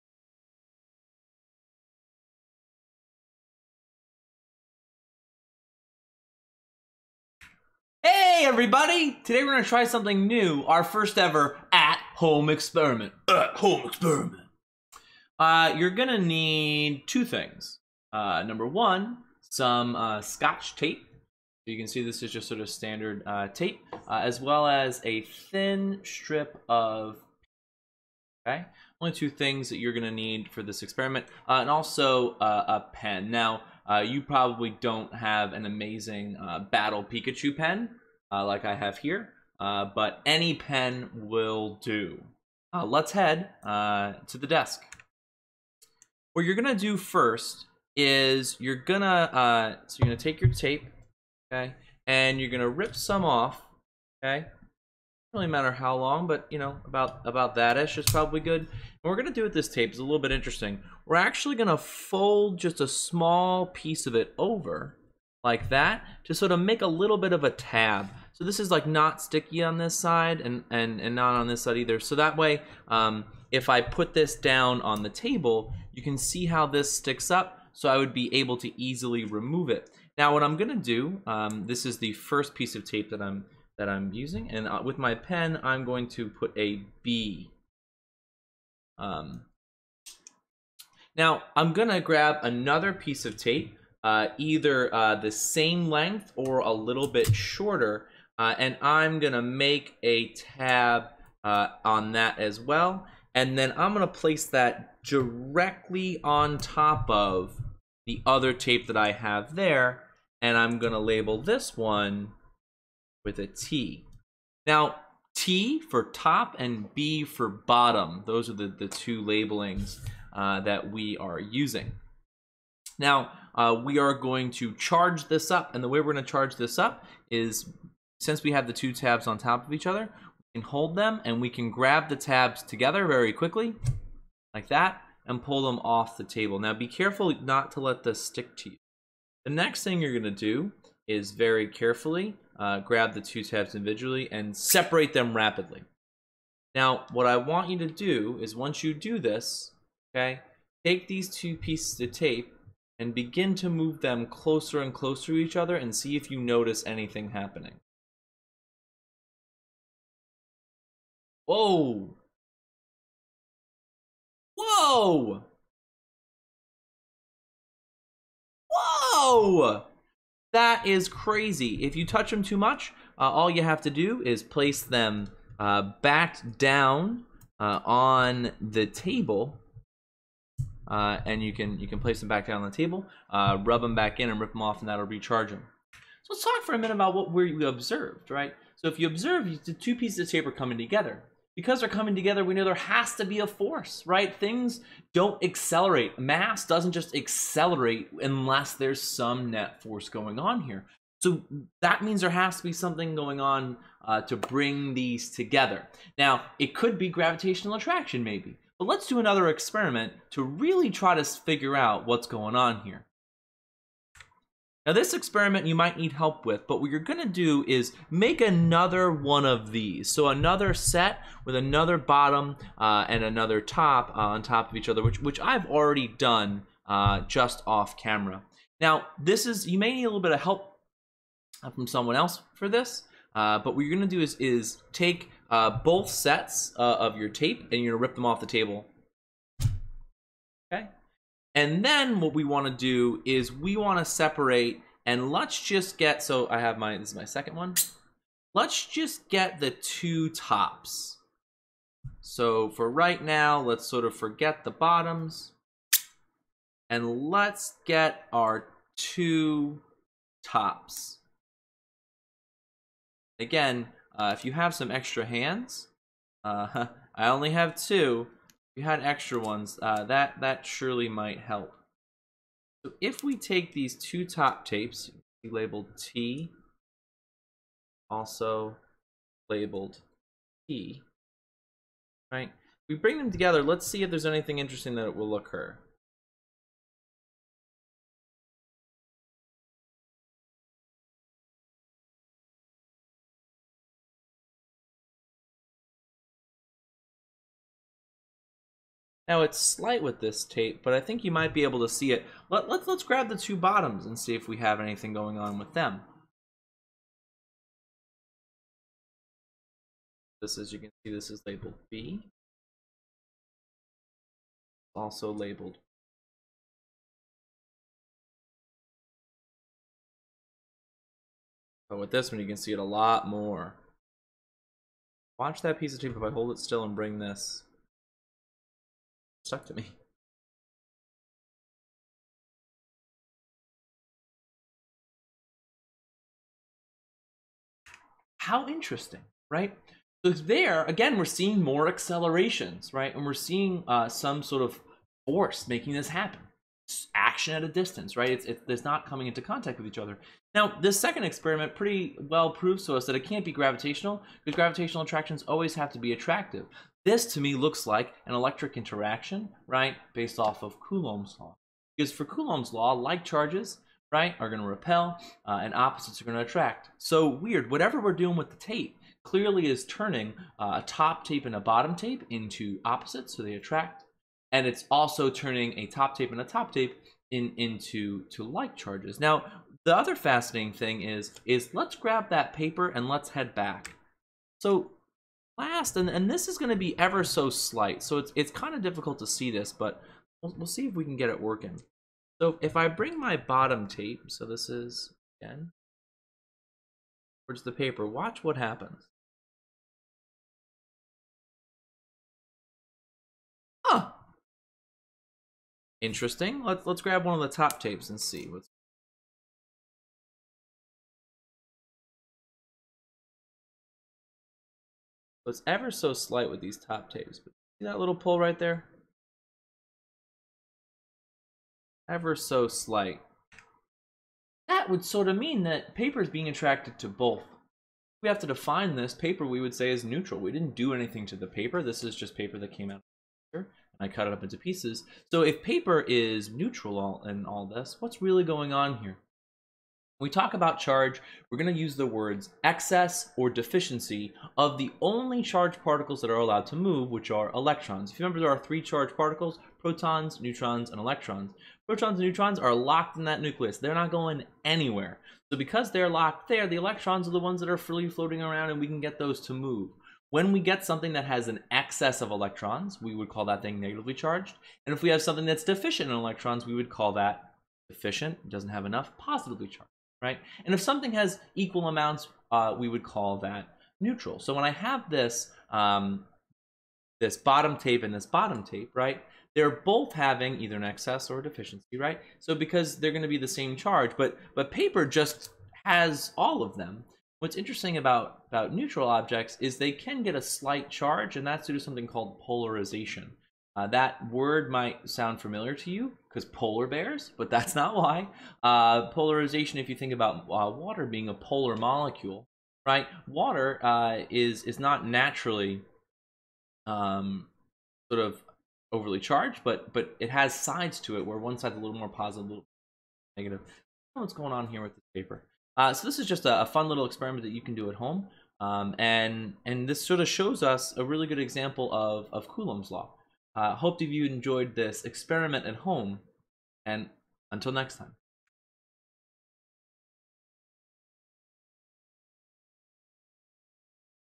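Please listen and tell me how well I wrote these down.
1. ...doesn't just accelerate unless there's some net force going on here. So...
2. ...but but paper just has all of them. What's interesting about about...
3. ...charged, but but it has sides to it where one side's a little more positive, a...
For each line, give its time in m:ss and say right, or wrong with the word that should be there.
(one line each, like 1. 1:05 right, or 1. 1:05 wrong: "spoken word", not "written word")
1. 3:16 right
2. 8:04 right
3. 8:29 right.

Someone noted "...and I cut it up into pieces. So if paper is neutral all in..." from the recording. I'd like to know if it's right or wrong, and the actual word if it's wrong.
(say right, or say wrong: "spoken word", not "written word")
right.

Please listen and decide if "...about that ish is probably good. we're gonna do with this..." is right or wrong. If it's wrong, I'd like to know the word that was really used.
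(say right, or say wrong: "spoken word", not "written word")
right.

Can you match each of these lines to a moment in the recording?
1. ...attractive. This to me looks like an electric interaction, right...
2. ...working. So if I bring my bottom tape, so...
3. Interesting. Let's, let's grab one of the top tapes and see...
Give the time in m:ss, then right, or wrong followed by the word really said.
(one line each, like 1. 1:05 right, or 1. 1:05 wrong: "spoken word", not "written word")
1. 5:56 right
2. 6:31 right
3. 6:46 right.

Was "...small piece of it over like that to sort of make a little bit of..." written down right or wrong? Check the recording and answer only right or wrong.
right.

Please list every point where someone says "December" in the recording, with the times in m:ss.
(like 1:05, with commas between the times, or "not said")
not said.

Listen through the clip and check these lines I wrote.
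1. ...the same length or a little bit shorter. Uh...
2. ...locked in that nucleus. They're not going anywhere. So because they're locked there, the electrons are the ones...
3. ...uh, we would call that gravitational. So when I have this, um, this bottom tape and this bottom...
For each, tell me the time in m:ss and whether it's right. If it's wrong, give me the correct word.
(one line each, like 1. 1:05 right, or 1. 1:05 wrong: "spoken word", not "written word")
1. 1:35 right
2. 7:32 right
3. 7:52 wrong: "neutral", not "gravitational".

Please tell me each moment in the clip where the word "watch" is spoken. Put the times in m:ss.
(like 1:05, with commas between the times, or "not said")
5:25, 6:38.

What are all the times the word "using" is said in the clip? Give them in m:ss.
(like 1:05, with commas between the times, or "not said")
1:24, 2:01.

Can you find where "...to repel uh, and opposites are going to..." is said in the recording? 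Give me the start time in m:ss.
6:04.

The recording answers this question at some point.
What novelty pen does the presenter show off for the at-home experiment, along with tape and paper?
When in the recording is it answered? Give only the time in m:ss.
0:36.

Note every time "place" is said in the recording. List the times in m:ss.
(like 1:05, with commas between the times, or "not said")
1:44, 2:54, 3:01.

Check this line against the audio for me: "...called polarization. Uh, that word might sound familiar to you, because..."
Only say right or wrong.
right.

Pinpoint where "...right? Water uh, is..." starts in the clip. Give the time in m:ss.
8:22.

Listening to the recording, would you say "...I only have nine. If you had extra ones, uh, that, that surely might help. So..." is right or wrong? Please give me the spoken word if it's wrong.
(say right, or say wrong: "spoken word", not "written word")
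wrong: "two", not "nine".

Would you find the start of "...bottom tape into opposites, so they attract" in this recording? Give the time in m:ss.
6:11.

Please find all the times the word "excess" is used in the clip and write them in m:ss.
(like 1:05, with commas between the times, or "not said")
7:22, 7:41, 8:00.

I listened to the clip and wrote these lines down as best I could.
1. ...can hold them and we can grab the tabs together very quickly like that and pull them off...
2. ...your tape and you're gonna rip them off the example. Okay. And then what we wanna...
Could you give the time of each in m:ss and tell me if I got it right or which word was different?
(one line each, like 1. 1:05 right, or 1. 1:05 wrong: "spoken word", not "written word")
1. 2:10 right
2. 3:57 wrong: "table", not "example".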